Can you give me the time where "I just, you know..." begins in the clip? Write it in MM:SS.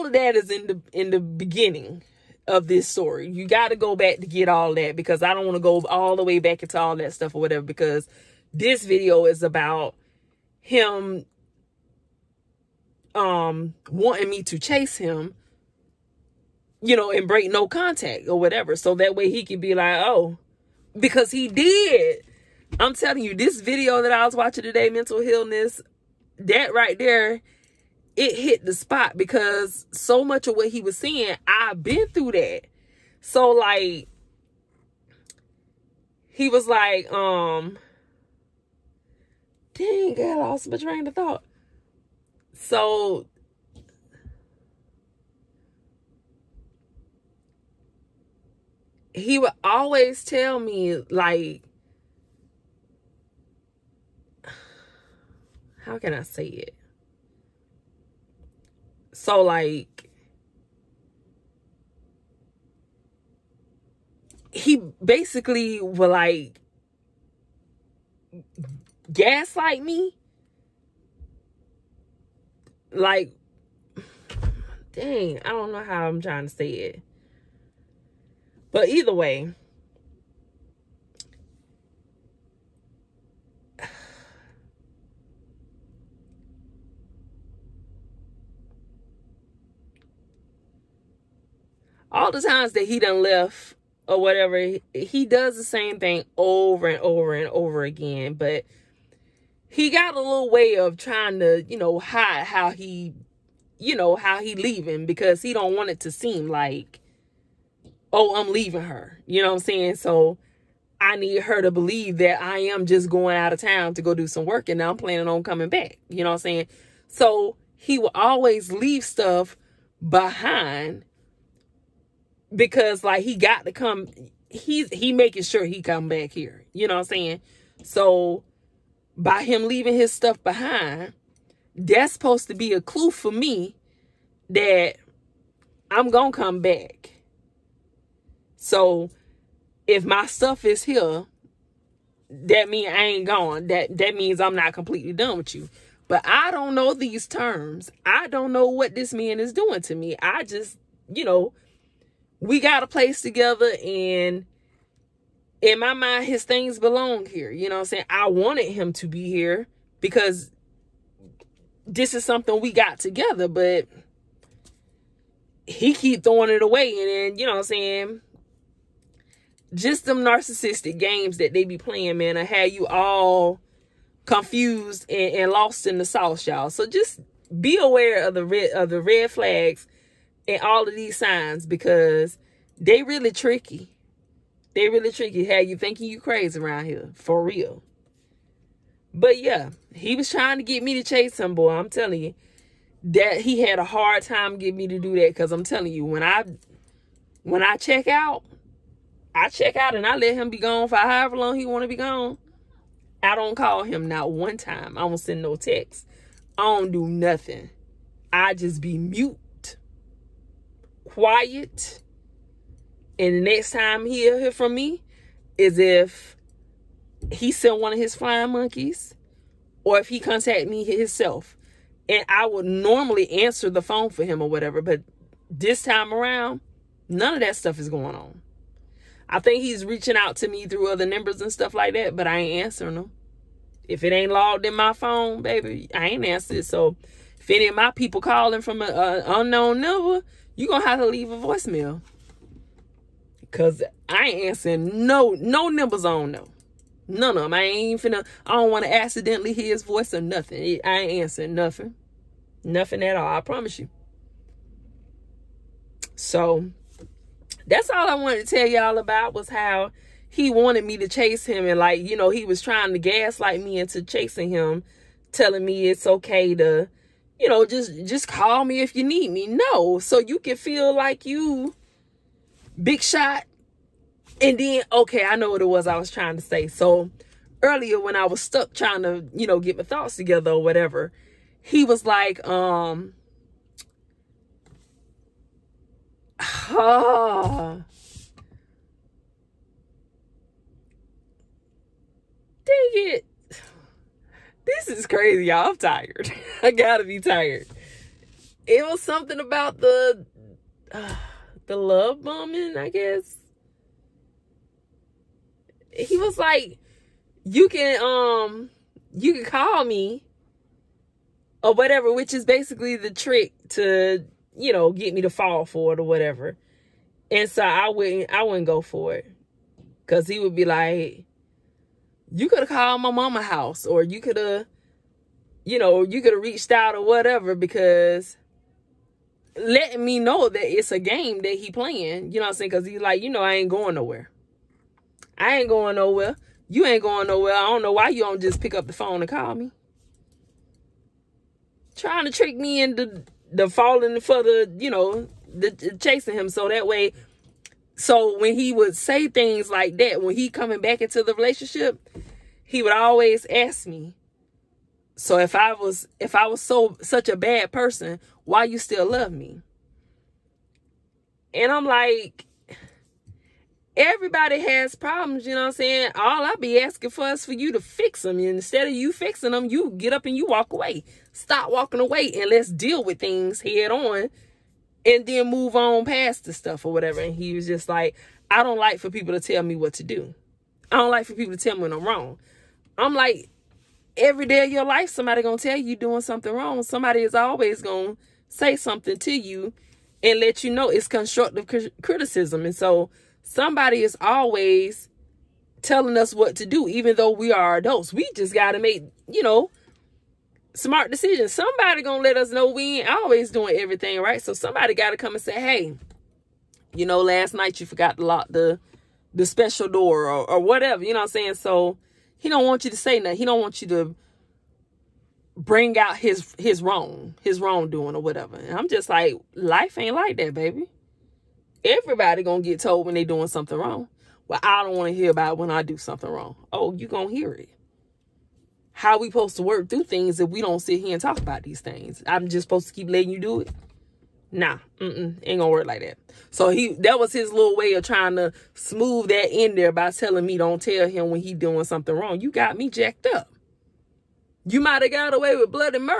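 02:30.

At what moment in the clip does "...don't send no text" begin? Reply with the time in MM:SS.
03:25.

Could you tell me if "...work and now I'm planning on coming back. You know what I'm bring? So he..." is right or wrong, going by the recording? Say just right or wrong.
wrong.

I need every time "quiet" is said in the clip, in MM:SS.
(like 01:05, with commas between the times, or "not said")
03:31.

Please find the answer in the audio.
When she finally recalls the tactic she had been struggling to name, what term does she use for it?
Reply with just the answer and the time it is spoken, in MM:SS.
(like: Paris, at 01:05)
love bombing, at 05:01.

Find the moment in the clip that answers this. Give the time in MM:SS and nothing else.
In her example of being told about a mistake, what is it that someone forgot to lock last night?
06:49.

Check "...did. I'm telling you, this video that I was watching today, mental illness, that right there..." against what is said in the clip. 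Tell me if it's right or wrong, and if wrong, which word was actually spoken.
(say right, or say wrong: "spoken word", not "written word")
right.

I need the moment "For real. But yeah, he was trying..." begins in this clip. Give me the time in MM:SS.
03:07.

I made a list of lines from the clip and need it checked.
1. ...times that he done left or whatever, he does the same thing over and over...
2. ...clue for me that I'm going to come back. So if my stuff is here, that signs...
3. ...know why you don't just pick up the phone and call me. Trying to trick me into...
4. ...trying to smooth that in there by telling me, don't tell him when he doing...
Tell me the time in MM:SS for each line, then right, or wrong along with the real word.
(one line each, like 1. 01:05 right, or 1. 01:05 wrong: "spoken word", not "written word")
1. 01:32 right
2. 02:12 wrong: "means", not "signs"
3. 05:37 right
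4. 07:18 right.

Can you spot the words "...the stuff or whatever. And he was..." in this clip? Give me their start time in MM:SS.
06:16.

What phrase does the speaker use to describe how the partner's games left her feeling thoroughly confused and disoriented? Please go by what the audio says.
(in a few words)
lost in the sauce.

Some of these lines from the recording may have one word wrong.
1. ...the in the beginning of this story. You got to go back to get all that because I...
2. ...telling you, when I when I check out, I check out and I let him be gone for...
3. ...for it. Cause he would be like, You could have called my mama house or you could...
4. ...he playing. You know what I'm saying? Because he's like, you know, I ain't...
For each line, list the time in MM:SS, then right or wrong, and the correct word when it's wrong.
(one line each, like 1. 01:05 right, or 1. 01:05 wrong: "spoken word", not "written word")
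1. 00:00 right
2. 03:15 right
3. 05:18 right
4. 05:31 right.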